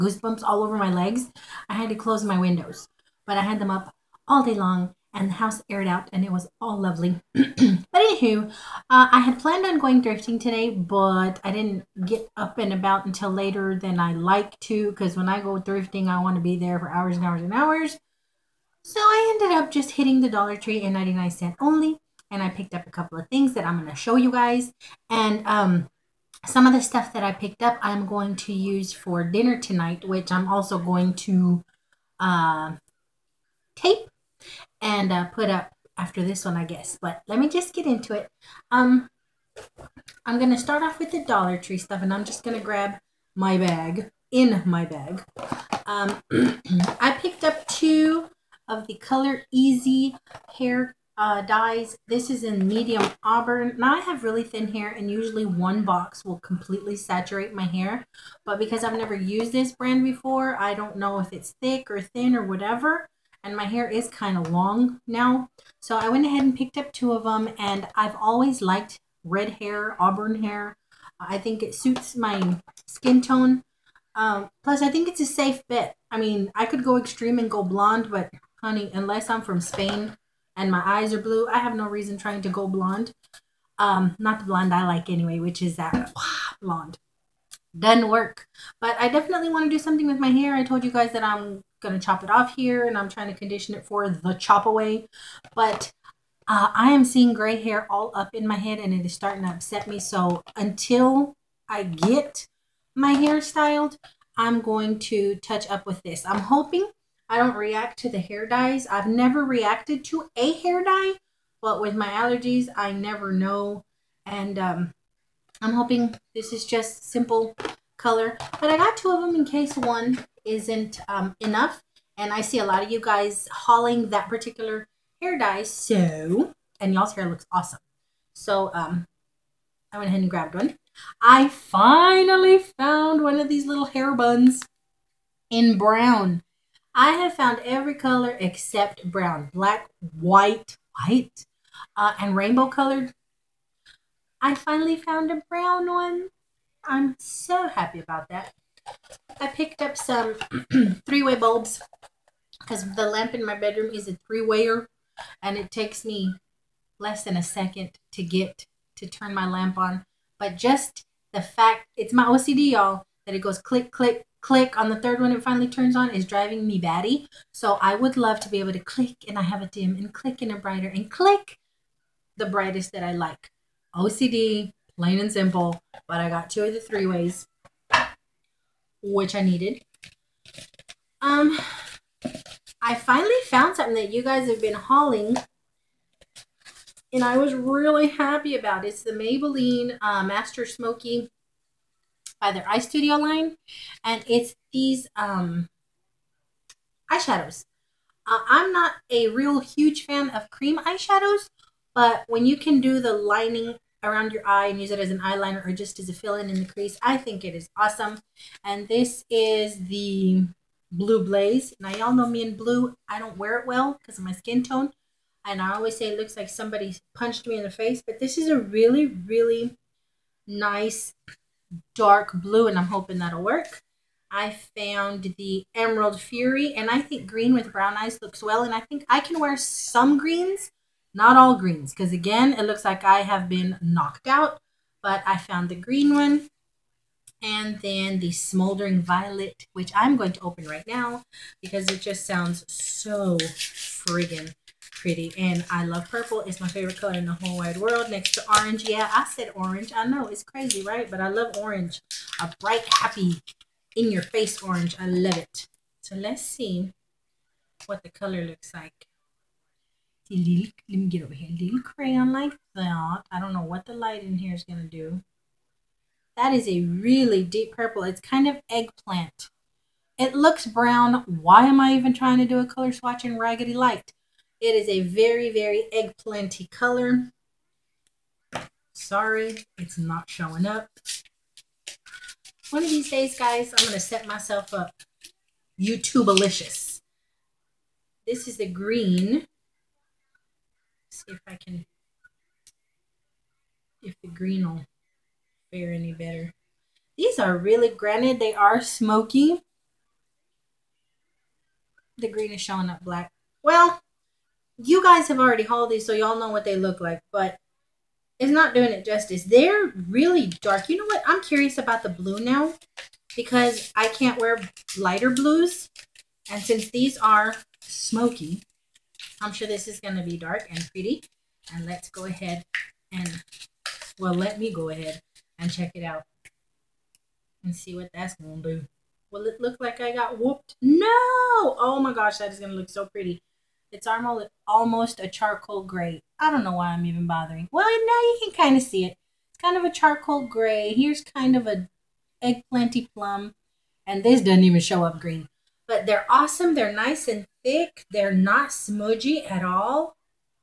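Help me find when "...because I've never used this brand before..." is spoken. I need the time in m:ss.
0:58.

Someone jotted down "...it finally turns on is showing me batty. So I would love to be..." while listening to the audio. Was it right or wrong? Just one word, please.
wrong.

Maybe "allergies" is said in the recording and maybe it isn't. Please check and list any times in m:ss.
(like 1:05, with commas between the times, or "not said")
1:52.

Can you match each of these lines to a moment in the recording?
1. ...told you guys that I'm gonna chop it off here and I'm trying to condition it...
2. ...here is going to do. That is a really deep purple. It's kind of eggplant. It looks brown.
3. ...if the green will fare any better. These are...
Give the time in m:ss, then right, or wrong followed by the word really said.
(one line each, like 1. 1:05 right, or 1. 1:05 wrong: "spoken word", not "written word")
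1. 1:30 right
2. 4:24 right
3. 4:54 right.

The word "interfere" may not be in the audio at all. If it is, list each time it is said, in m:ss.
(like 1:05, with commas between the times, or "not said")
not said.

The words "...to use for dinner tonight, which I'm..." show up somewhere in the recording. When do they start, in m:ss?
0:28.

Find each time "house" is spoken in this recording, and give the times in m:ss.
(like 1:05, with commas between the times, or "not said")
0:05.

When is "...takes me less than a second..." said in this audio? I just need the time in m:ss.
2:35.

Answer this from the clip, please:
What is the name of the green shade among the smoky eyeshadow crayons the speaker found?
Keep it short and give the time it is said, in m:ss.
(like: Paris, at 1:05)
Emerald Fury, at 3:45.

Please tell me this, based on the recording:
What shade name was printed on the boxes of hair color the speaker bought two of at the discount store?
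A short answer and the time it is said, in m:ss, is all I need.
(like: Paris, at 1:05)
Medium auburn, at 0:52.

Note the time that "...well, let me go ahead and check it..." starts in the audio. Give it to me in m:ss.
5:24.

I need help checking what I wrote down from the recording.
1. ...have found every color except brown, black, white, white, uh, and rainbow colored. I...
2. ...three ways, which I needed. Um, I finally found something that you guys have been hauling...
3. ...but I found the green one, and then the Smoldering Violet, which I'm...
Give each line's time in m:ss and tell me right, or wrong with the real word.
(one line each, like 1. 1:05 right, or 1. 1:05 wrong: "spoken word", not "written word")
1. 2:17 right
2. 2:56 right
3. 3:55 right.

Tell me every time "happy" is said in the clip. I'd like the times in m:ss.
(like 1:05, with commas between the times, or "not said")
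2:27, 3:08, 4:12.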